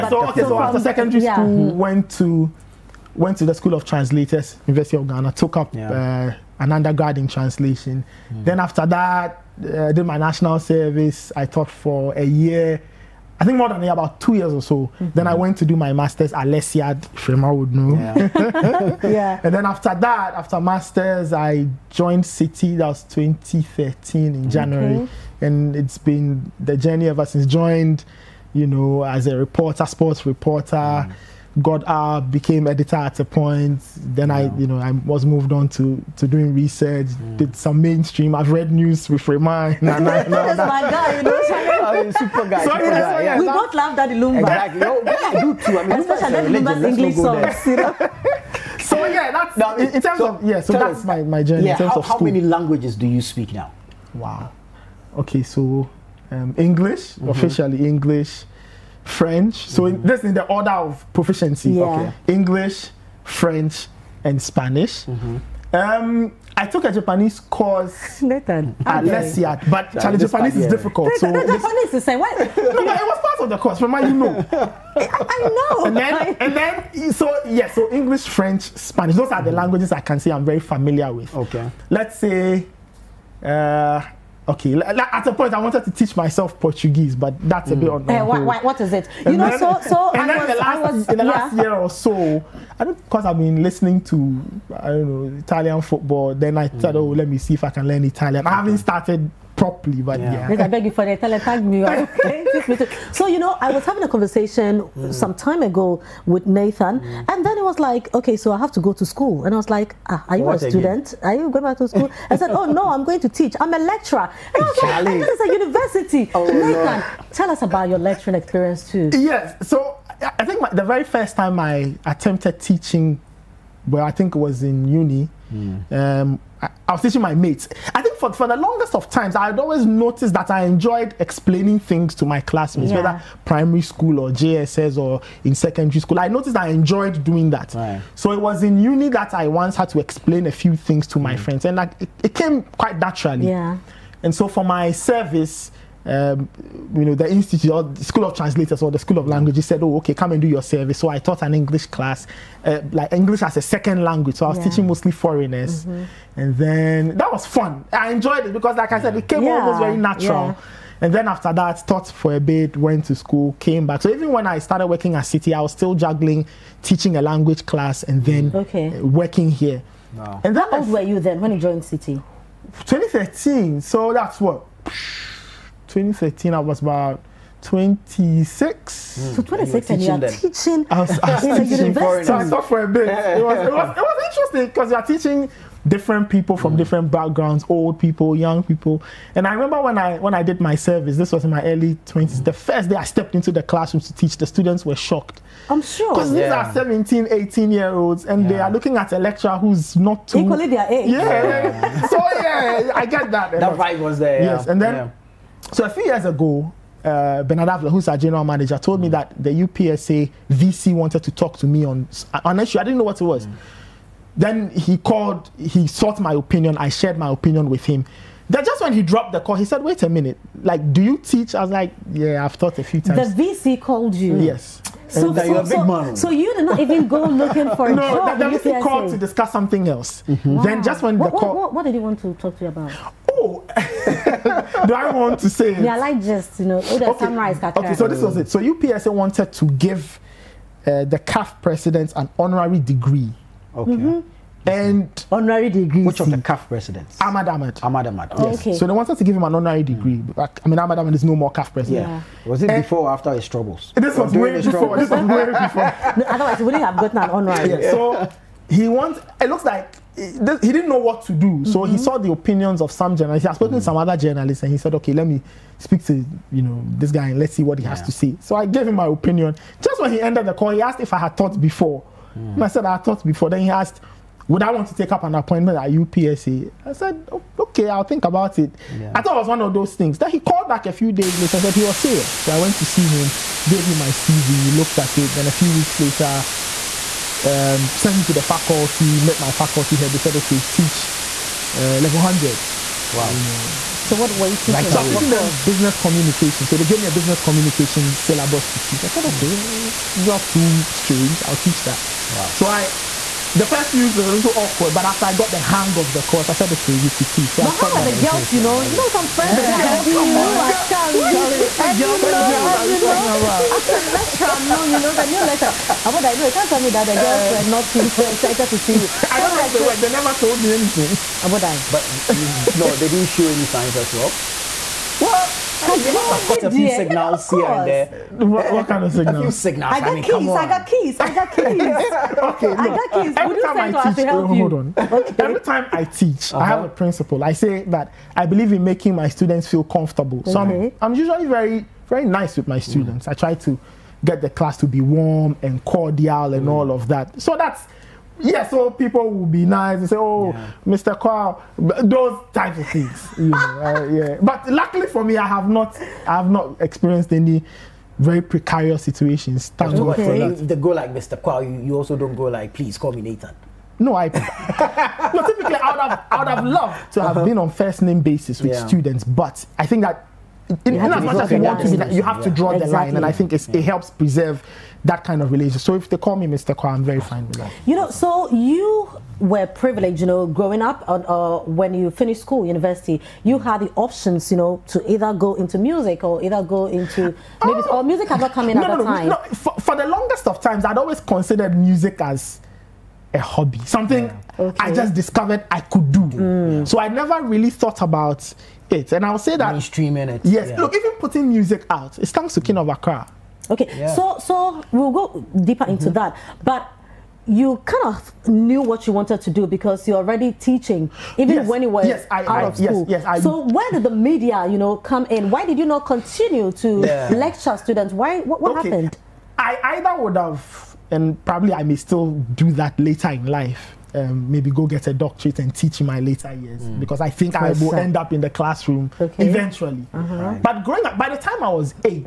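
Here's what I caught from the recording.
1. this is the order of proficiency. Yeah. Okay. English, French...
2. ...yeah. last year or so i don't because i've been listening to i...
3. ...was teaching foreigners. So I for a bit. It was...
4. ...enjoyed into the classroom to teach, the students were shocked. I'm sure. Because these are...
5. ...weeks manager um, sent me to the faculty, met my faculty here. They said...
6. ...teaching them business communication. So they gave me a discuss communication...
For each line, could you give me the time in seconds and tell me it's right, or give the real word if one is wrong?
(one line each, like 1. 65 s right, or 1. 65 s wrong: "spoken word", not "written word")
1. 60 s right
2. 91 s right
3. 181 s right
4. 193 s wrong: "stepped", not "enjoyed"
5. 285 s wrong: "later", not "manager"
6. 295 s wrong: "business", not "discuss".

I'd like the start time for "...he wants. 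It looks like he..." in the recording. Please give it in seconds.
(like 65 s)
258 s.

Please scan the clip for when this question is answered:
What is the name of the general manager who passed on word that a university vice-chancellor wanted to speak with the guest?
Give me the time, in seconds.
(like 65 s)
207 s.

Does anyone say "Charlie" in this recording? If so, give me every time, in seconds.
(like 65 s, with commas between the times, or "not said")
70 s, 114 s.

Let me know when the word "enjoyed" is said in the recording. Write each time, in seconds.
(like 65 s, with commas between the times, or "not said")
130 s, 136 s, 158 s.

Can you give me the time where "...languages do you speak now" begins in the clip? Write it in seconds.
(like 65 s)
52 s.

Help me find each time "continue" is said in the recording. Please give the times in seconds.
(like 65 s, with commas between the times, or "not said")
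416 s.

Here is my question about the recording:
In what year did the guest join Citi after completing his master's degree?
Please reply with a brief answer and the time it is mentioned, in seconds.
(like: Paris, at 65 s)
2013, at 23 s.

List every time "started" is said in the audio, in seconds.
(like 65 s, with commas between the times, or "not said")
98 s, 164 s.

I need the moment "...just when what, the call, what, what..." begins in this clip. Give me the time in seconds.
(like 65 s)
230 s.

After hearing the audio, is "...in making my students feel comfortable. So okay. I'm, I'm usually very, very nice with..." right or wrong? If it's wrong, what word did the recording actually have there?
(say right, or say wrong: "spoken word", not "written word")
right.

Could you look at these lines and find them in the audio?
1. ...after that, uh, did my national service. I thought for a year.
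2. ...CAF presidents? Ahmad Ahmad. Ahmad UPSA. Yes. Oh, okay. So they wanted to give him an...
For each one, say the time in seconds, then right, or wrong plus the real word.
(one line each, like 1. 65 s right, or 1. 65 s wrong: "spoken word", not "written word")
1. 8 s wrong: "taught", not "thought"
2. 246 s wrong: "Ahmad", not "UPSA".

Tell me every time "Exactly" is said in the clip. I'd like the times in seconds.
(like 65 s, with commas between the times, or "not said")
44 s.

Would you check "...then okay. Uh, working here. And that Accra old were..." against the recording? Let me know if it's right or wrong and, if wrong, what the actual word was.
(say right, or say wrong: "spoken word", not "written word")
wrong: "How", not "Accra".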